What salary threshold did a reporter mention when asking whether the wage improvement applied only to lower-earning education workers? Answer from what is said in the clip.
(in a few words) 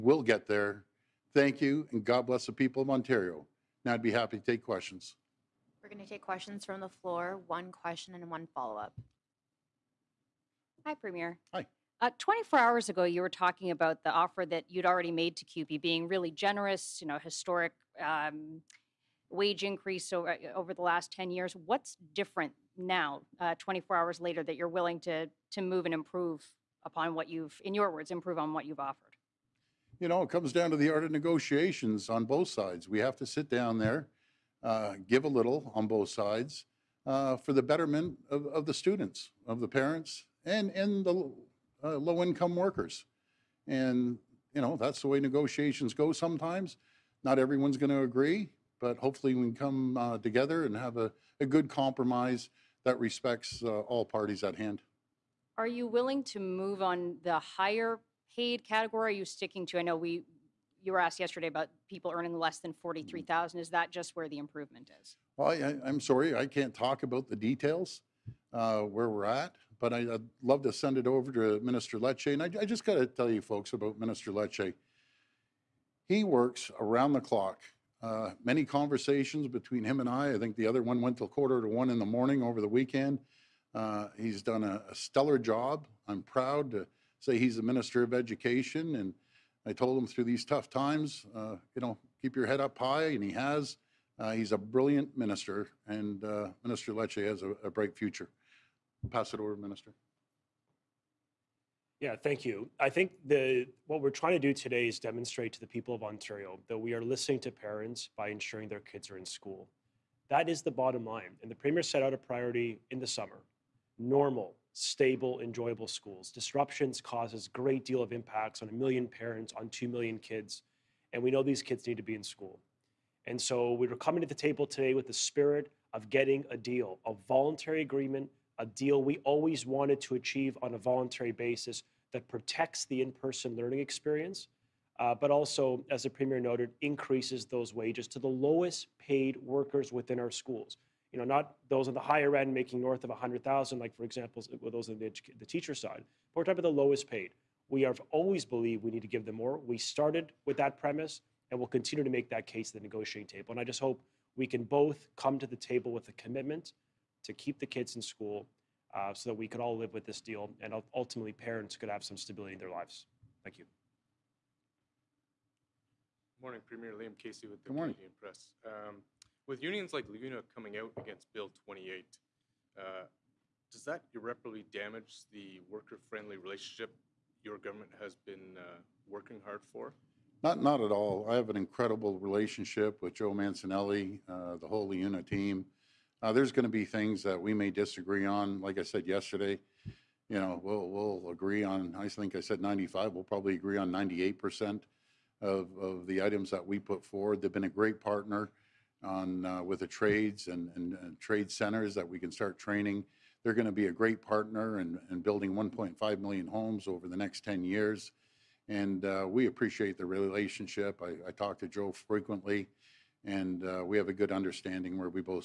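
43,000.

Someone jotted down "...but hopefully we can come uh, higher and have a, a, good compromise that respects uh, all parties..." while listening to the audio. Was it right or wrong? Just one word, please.
wrong.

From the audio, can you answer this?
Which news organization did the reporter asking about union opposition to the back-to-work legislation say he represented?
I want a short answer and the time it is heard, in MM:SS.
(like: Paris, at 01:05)
Canadian Press, at 02:47.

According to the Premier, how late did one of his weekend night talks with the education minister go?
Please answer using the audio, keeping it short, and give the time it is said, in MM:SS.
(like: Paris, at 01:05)
quarter to one, at 01:21.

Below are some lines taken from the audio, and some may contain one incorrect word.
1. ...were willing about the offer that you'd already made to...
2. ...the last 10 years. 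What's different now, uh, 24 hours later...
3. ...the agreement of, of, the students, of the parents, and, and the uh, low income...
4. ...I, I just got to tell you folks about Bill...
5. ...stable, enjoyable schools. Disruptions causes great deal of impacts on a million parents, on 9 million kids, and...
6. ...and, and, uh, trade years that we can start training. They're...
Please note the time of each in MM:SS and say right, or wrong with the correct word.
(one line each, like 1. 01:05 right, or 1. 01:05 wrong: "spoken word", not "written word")
1. 00:13 wrong: "talking", not "willing"
2. 00:20 right
3. 00:37 wrong: "betterment", not "agreement"
4. 01:12 wrong: "Minister", not "Bill"
5. 01:54 wrong: "2", not "9"
6. 03:20 wrong: "centers", not "years".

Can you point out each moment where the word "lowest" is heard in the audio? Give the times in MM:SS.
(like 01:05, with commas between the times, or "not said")
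02:18, 02:26.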